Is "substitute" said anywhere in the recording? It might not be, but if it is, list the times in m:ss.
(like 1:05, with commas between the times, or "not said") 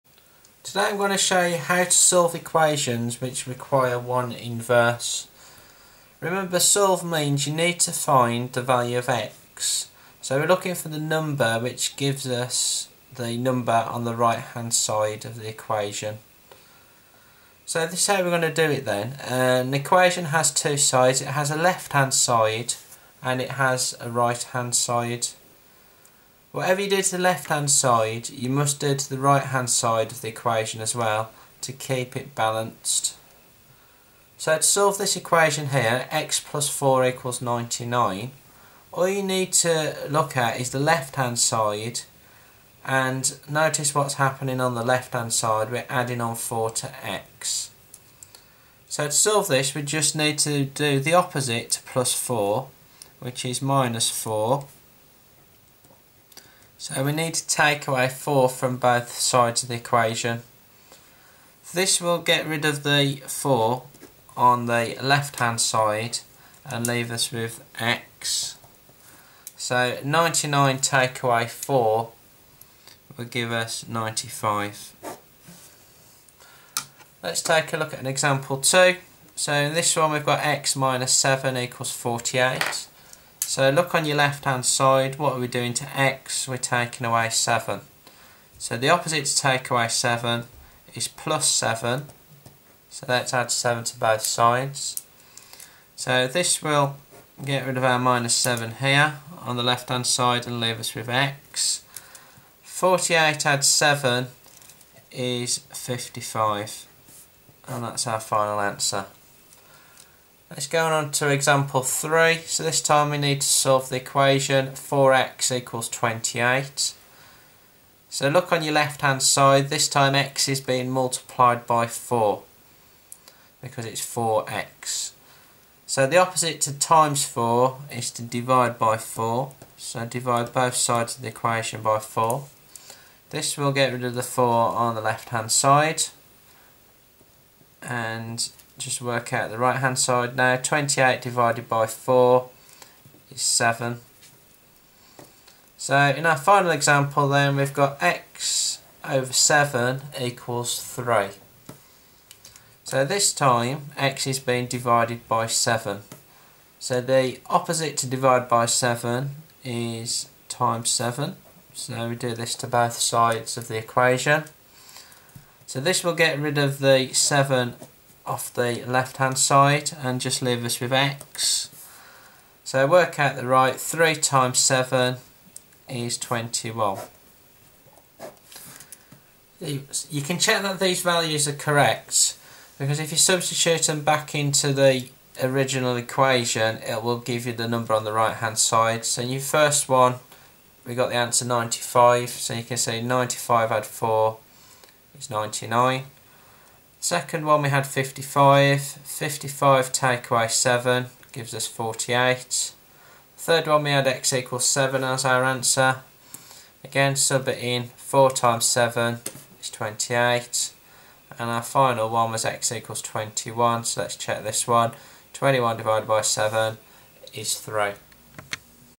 3:03.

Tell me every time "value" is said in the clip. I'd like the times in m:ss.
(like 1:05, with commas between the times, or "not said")
0:08, 3:01.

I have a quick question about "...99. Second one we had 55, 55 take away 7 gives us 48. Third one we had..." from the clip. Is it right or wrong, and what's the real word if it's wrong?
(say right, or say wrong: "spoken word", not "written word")
right.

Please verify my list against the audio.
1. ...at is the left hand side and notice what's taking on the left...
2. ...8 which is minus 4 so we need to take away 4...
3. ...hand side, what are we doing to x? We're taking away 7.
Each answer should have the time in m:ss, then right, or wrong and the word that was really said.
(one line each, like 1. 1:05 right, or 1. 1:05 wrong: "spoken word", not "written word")
1. 0:40 wrong: "happening", not "taking"
2. 0:52 wrong: "4", not "8"
3. 1:24 right.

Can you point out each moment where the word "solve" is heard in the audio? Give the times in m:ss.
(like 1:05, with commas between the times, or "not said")
0:01, 0:06, 0:34, 0:49, 1:53.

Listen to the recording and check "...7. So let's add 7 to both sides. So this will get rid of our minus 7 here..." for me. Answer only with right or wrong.
right.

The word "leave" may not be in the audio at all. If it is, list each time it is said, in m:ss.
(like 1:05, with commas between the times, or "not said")
1:06, 1:40, 2:50.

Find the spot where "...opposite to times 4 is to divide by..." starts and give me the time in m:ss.
2:06.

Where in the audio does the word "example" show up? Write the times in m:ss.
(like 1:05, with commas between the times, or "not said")
1:18, 1:51, 2:26.